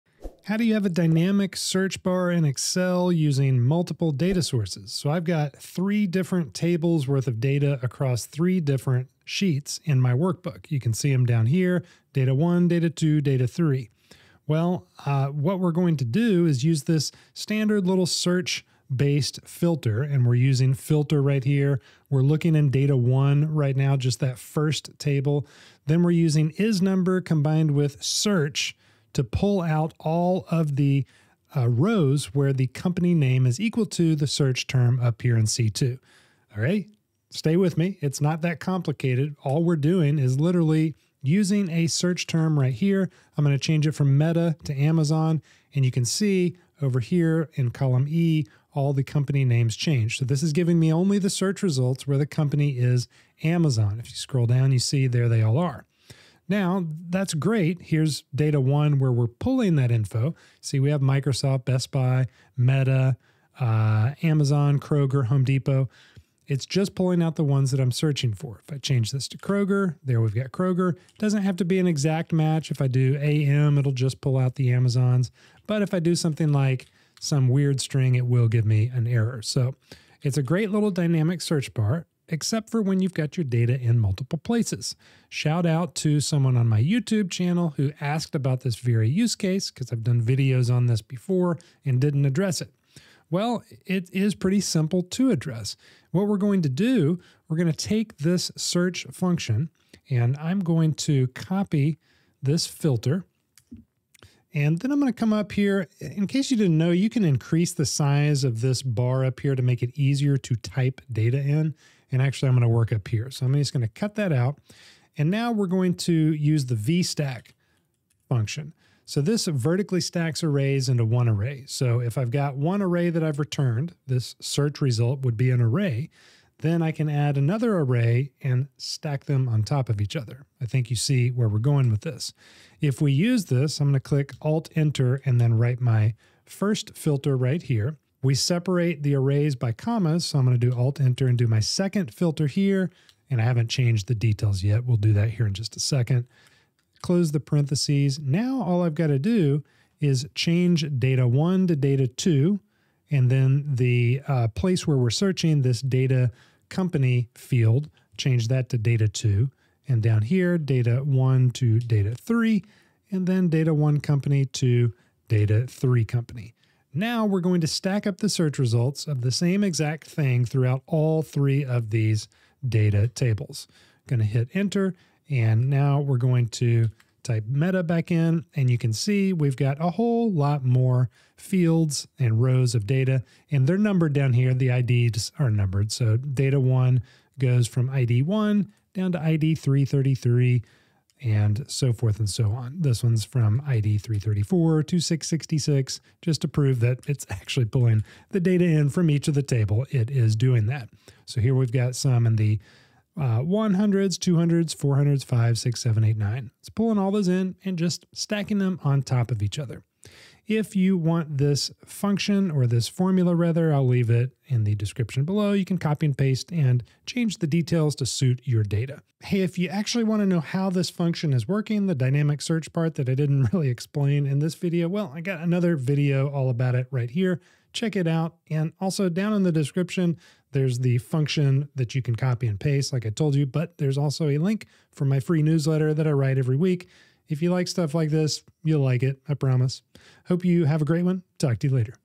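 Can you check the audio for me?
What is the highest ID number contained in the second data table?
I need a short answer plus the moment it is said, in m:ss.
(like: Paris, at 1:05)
666, at 3:14.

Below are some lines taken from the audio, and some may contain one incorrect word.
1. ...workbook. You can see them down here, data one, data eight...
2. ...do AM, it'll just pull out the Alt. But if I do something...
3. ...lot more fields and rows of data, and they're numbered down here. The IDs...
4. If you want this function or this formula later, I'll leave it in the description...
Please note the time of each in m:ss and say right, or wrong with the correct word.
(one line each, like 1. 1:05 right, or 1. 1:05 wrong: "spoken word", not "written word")
1. 0:10 wrong: "two", not "eight"
2. 1:12 wrong: "Amazons", not "Alt"
3. 3:00 right
4. 3:30 wrong: "rather", not "later".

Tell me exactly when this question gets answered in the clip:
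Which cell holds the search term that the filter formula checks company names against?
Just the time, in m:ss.
0:35.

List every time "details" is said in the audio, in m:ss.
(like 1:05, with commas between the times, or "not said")
2:24, 3:37.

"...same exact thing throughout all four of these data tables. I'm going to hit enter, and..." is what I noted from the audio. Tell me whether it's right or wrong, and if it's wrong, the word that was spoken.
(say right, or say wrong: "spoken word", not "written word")
wrong: "three", not "four".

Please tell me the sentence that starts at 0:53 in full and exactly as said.
If you scroll down, you see there they all are.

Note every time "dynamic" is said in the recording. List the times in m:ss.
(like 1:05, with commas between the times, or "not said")
0:00, 1:20, 3:41.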